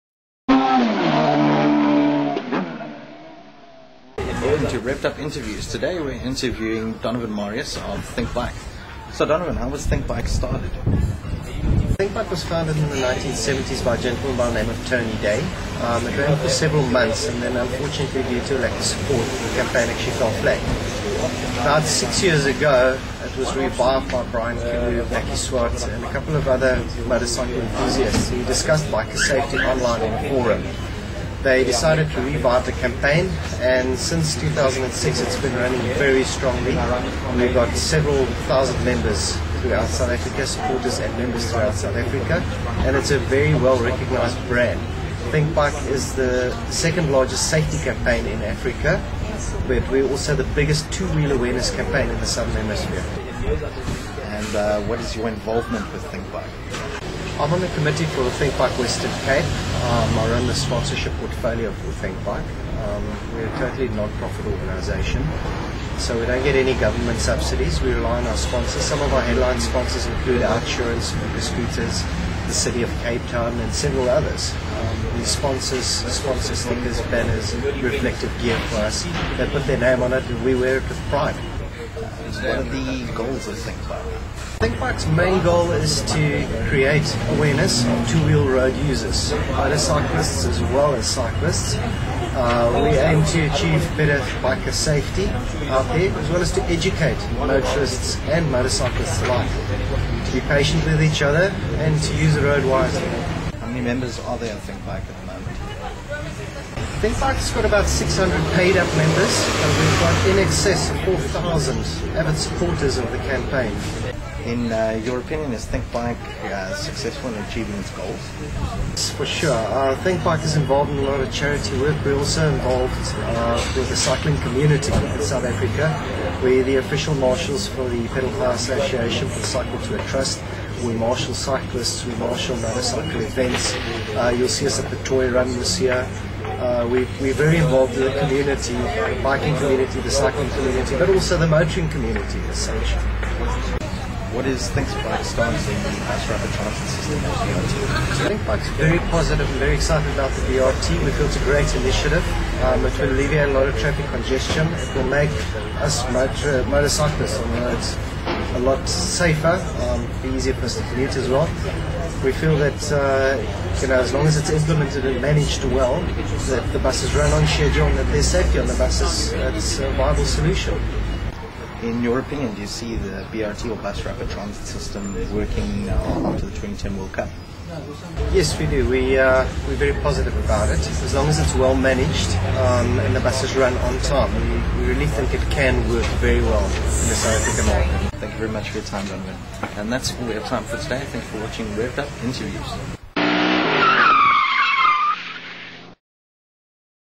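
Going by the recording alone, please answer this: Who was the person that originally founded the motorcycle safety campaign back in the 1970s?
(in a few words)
Tony Day.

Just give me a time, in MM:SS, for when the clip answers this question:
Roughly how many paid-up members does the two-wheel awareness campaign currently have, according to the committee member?
01:47.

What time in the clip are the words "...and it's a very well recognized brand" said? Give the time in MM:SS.
00:42.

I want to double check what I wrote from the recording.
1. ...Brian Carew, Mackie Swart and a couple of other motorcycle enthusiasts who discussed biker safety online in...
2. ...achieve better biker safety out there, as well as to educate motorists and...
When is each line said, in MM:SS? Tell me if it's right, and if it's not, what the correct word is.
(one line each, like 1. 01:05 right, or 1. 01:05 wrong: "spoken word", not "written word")
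1. 00:24 right
2. 01:33 right.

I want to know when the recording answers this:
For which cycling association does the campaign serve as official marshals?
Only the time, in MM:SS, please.
02:08.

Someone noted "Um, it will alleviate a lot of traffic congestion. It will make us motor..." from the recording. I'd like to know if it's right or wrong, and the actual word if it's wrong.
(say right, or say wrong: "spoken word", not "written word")
right.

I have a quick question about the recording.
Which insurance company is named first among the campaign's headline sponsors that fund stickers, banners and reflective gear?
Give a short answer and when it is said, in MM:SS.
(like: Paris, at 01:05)
Outsurance, at 01:10.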